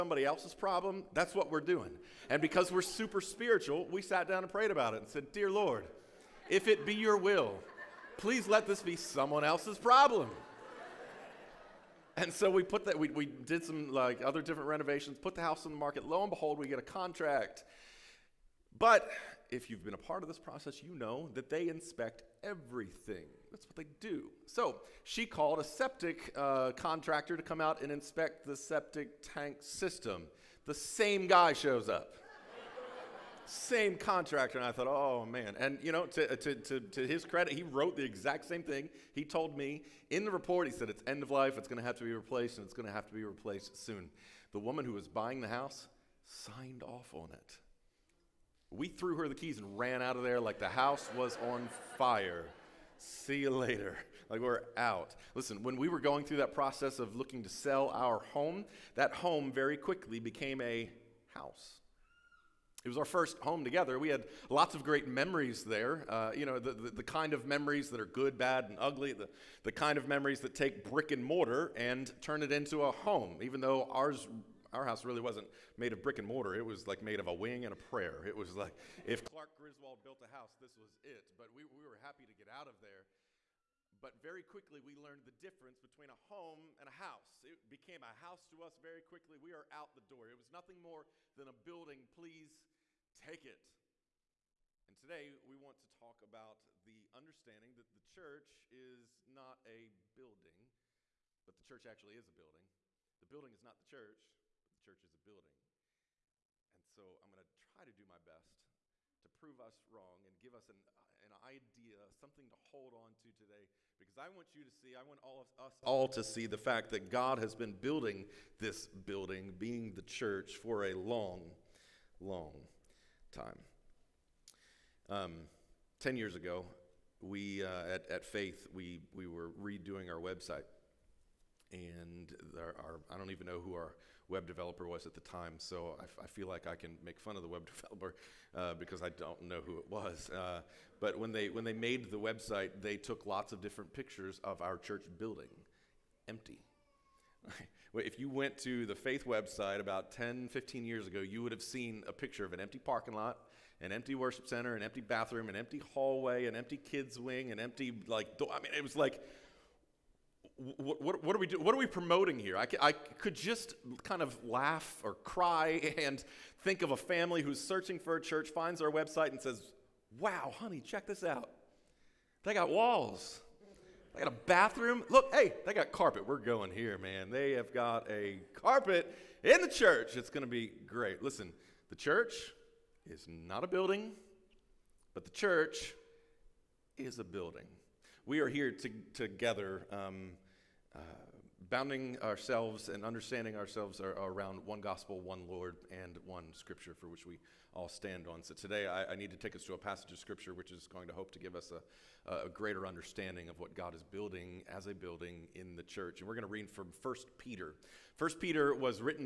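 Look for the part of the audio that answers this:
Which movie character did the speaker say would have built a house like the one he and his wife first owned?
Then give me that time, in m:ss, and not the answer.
1:19.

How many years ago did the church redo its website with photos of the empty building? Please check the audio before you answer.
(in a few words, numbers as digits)
10.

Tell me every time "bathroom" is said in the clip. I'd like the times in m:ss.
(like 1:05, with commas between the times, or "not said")
2:34, 2:54.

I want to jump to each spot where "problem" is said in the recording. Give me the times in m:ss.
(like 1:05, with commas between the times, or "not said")
0:00, 0:09.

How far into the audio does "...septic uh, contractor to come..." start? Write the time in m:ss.
0:25.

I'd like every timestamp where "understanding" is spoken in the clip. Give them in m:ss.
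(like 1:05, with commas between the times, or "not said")
1:37, 3:13, 3:22.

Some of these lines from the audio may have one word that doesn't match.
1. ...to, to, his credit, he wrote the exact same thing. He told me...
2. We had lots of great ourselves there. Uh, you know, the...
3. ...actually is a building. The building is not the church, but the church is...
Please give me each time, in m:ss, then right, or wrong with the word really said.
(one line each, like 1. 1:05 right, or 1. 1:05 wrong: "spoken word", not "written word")
1. 0:36 right
2. 1:03 wrong: "memories", not "ourselves"
3. 1:41 right.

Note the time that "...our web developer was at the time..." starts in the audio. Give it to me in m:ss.
2:13.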